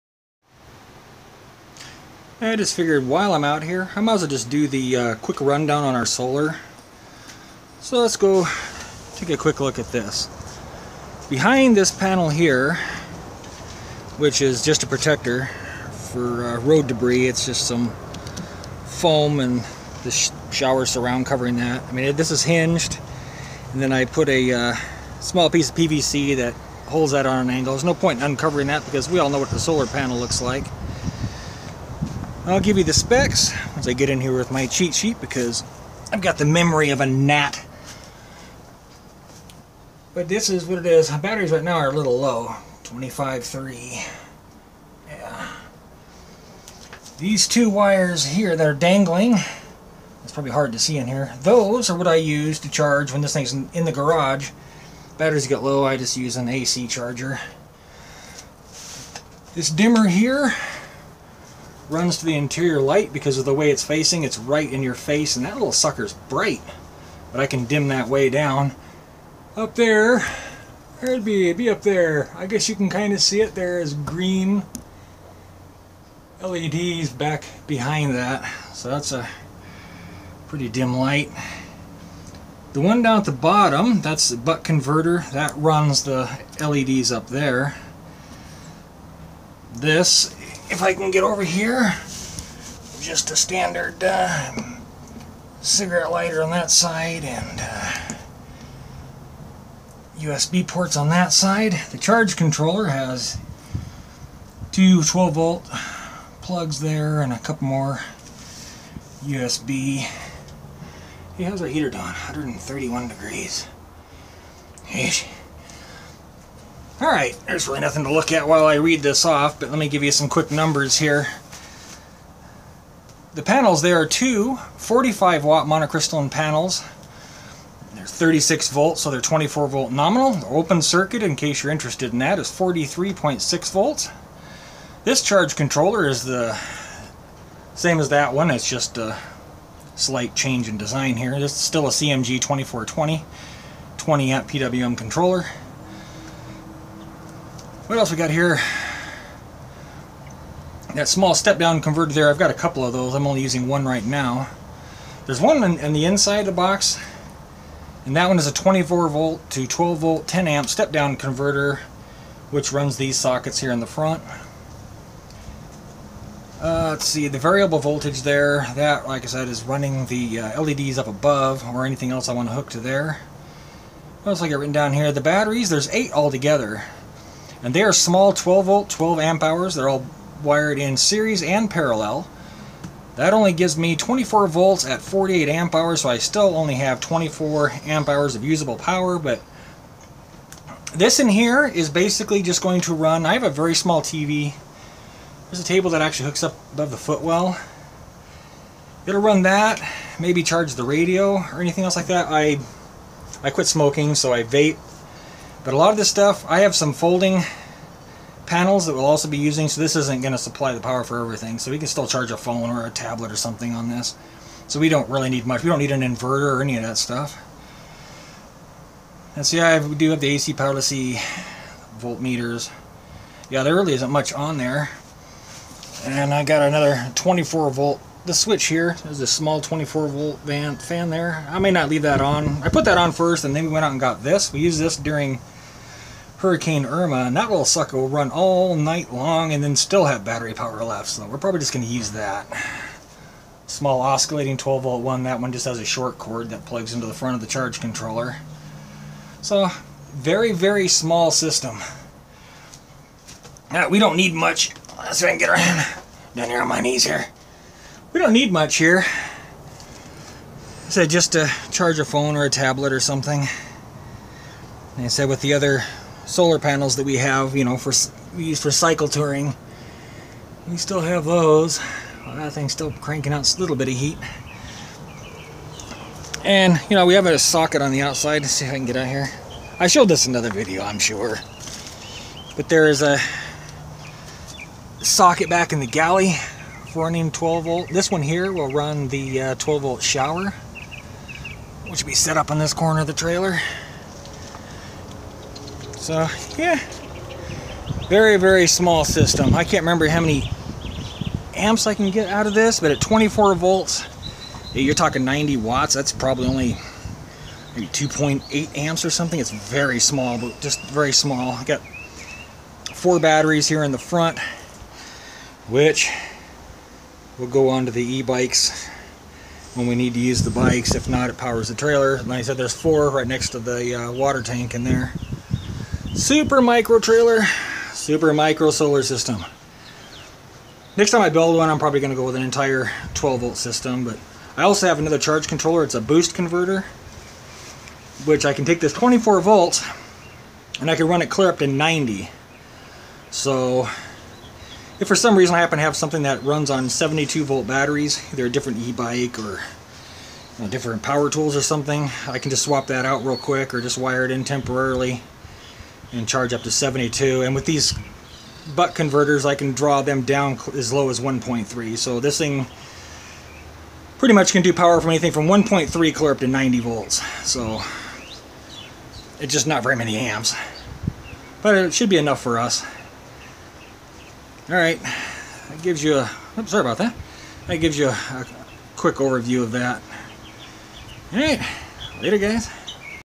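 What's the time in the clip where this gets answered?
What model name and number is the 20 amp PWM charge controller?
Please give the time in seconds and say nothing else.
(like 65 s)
141 s.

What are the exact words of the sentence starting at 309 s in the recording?
It's very small, but just very small.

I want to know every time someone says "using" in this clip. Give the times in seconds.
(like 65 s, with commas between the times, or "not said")
153 s, 209 s.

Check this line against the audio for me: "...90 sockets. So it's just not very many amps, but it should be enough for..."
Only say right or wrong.
wrong.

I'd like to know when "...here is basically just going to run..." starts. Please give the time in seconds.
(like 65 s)
191 s.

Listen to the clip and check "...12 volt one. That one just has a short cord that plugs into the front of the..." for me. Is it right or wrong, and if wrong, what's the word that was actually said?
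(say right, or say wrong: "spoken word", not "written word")
right.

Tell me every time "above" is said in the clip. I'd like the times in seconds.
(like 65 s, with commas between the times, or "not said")
171 s, 196 s.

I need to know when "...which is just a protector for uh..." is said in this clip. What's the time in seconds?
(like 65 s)
14 s.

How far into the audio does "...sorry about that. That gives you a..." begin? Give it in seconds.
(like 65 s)
376 s.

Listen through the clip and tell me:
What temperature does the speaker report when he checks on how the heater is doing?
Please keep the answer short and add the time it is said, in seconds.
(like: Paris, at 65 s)
131 degrees, at 112 s.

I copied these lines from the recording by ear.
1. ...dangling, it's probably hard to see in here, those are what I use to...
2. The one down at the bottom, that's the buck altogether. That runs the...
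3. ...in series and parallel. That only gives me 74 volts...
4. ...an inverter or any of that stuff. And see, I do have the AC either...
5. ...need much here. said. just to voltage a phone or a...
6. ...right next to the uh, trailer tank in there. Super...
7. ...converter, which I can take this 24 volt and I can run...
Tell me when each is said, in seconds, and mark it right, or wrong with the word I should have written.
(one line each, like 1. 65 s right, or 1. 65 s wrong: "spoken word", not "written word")
1. 48 s right
2. 82 s wrong: "converter", not "altogether"
3. 180 s wrong: "24", not "74"
4. 215 s wrong: "power", not "either"
5. 258 s wrong: "charge", not "voltage"
6. 323 s wrong: "water", not "trailer"
7. 336 s right.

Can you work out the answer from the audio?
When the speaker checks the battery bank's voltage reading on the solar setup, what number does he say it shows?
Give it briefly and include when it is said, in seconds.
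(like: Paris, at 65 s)
25.3, at 42 s.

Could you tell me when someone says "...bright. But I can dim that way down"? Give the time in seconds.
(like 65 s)
66 s.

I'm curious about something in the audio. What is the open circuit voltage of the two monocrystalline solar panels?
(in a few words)
43.6 volts.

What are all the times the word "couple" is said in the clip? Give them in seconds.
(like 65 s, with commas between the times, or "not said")
107 s, 152 s.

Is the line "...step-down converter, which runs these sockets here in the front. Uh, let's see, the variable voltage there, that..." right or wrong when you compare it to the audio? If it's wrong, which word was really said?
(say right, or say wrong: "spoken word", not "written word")
right.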